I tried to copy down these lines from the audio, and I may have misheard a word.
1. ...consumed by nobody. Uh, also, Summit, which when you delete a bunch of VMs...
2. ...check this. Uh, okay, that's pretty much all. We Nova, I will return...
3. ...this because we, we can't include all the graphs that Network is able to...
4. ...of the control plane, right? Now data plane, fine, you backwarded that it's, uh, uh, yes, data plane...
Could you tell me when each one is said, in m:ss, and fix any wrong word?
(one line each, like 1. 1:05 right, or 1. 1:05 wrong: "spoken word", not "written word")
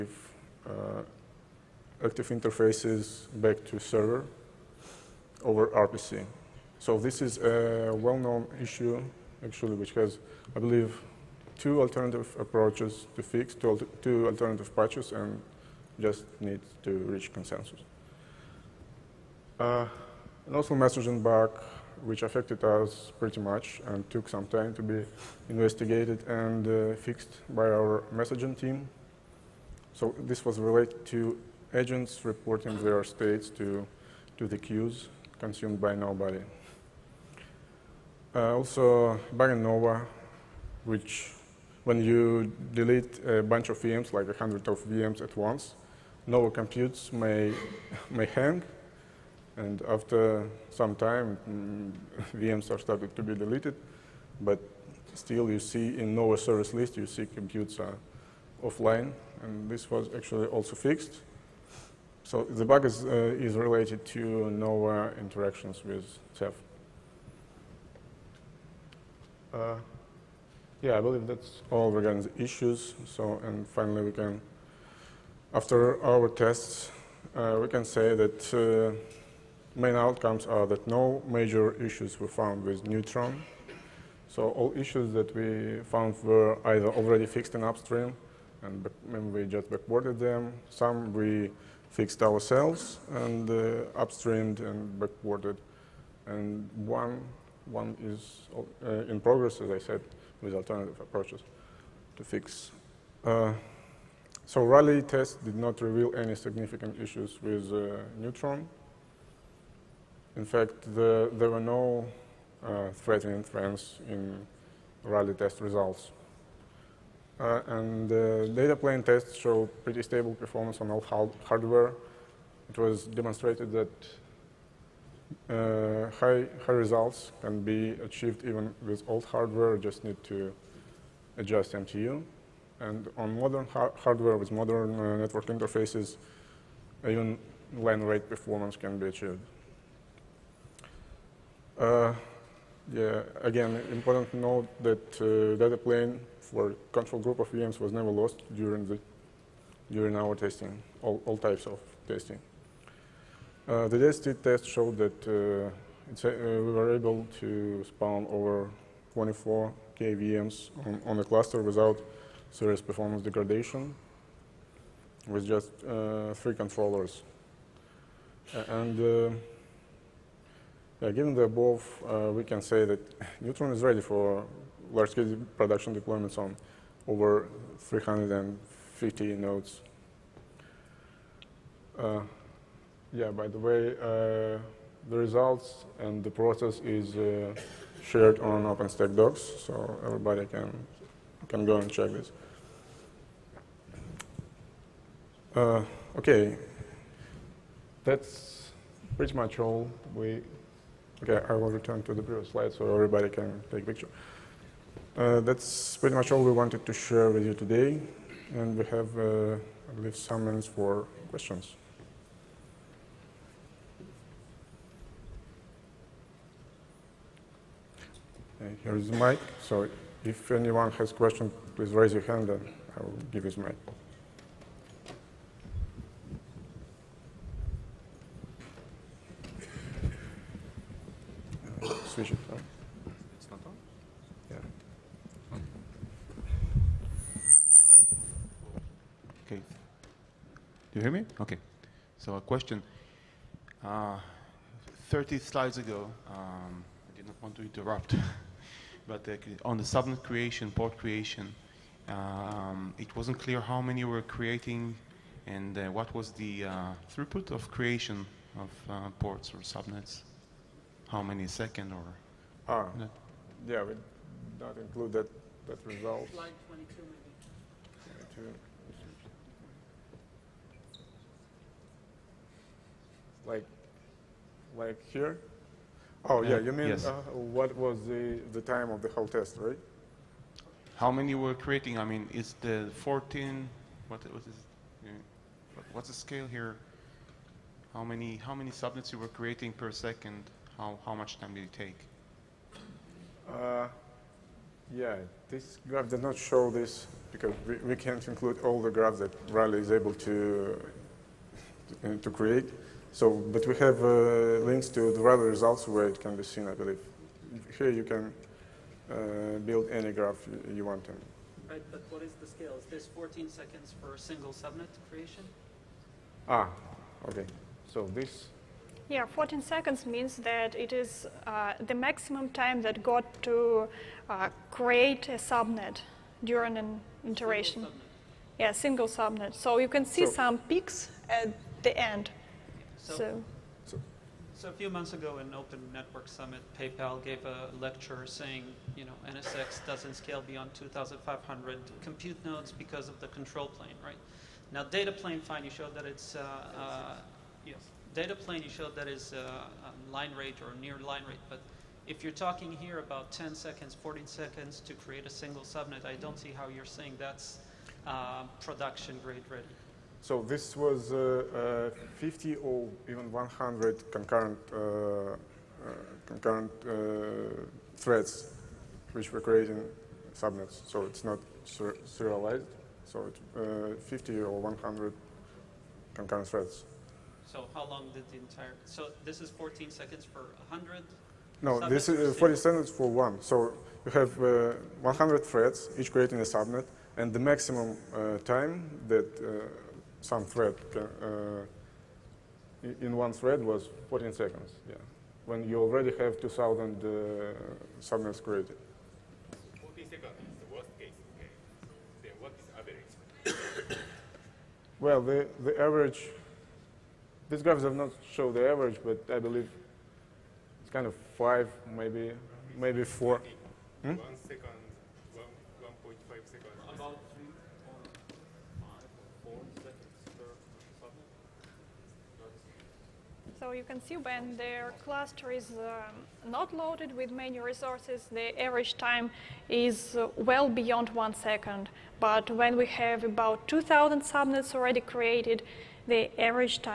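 1. 0:35 wrong: "Nova", not "Summit"
2. 3:11 wrong: "Okay", not "Nova"
3. 4:56 wrong: "Rally", not "Network"
4. 5:43 wrong: "showed", not "backwarded".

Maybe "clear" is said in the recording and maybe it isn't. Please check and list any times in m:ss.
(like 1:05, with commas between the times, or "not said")
4:13.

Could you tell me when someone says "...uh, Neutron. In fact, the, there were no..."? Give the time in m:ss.
1:47.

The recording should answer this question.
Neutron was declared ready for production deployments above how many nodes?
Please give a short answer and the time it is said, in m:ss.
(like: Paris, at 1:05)
350, at 2:57.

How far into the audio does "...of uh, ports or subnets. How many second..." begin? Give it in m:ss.
4:18.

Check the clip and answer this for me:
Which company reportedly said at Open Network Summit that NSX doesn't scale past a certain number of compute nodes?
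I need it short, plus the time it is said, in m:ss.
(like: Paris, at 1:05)
PayPal, at 5:36.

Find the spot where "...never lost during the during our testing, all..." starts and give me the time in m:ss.
2:27.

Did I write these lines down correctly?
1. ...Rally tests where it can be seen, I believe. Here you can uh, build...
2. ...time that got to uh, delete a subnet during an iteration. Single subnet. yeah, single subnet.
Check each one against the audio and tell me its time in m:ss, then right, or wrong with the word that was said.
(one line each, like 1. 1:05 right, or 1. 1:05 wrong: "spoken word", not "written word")
1. 5:05 wrong: "results", not "tests"
2. 5:22 wrong: "create", not "delete".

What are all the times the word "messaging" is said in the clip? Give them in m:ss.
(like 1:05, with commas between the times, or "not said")
0:20, 0:28.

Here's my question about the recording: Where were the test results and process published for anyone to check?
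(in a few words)
OpenStack docs.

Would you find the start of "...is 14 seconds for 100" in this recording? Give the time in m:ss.
6:19.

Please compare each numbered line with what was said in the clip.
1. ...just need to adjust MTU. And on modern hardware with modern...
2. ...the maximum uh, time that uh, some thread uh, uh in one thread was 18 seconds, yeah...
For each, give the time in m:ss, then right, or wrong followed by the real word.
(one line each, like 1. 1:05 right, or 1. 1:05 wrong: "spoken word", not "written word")
1. 2:09 right
2. 6:27 wrong: "14", not "18".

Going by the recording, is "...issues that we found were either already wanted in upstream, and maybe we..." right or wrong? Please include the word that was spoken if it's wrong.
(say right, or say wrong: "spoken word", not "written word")
wrong: "fixed", not "wanted".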